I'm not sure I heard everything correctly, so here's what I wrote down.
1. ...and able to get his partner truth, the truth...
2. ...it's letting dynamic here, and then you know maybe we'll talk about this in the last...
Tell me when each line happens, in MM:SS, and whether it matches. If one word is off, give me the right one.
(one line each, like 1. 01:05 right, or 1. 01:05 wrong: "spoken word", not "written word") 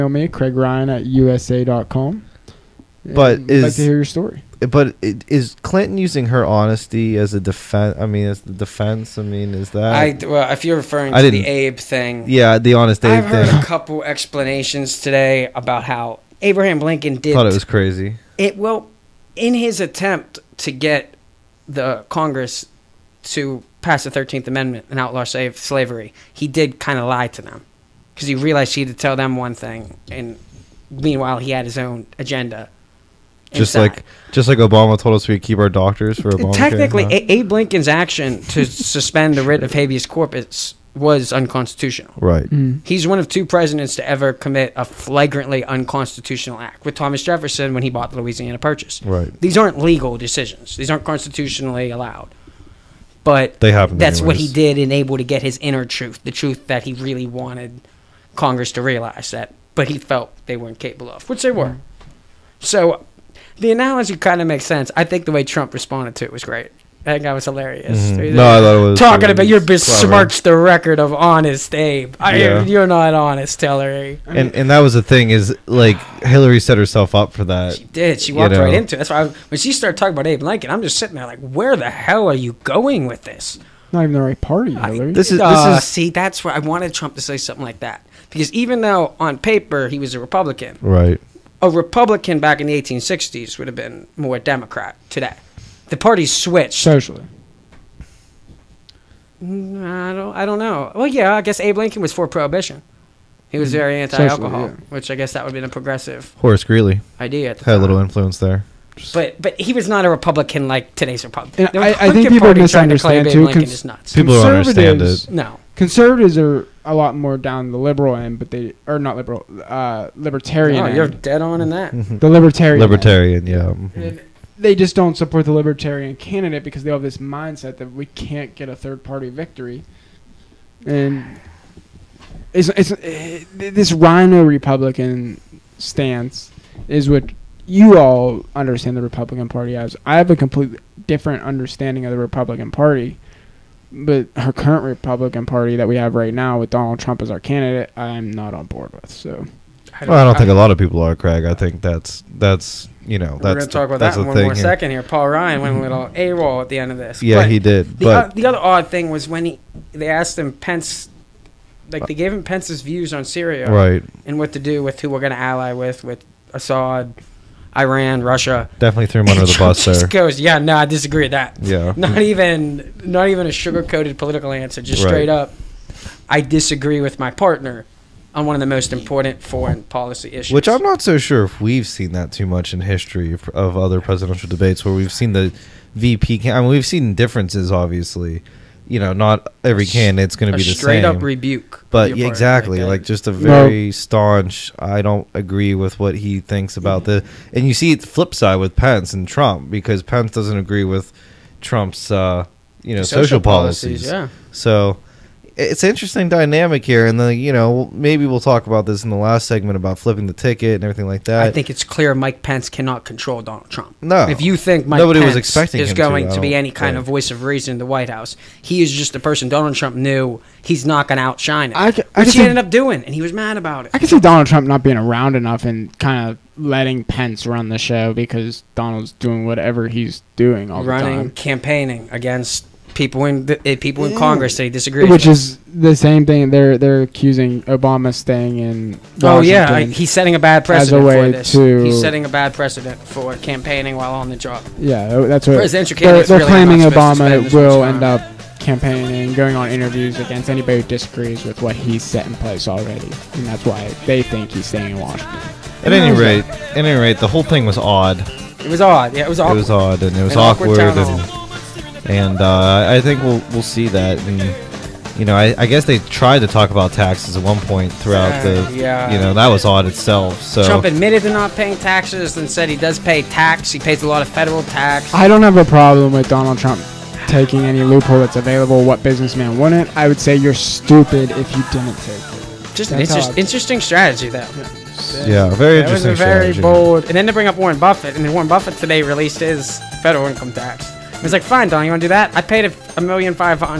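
1. 00:54 wrong: "inner", not "partner"
2. 03:25 wrong: "interesting", not "letting".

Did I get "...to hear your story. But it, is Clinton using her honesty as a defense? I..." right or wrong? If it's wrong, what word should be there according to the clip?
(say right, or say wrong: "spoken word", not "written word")
right.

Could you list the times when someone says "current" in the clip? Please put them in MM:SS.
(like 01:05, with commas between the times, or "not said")
02:24.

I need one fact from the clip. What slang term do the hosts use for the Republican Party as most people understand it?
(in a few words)
RINO.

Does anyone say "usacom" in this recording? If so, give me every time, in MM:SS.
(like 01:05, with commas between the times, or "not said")
00:01.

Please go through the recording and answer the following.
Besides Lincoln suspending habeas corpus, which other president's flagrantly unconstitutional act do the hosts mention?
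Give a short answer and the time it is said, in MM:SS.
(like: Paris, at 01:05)
Thomas Jefferson, at 00:46.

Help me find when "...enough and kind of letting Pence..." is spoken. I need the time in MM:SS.
03:45.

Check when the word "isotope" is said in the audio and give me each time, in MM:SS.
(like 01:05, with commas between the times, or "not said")
not said.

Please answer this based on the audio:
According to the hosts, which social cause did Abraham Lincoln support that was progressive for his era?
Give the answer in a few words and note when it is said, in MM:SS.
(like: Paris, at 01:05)
Prohibition, at 01:42.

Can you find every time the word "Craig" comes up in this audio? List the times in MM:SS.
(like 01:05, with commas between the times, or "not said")
00:00, 02:31.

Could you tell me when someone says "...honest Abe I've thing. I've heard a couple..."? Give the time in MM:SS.
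00:12.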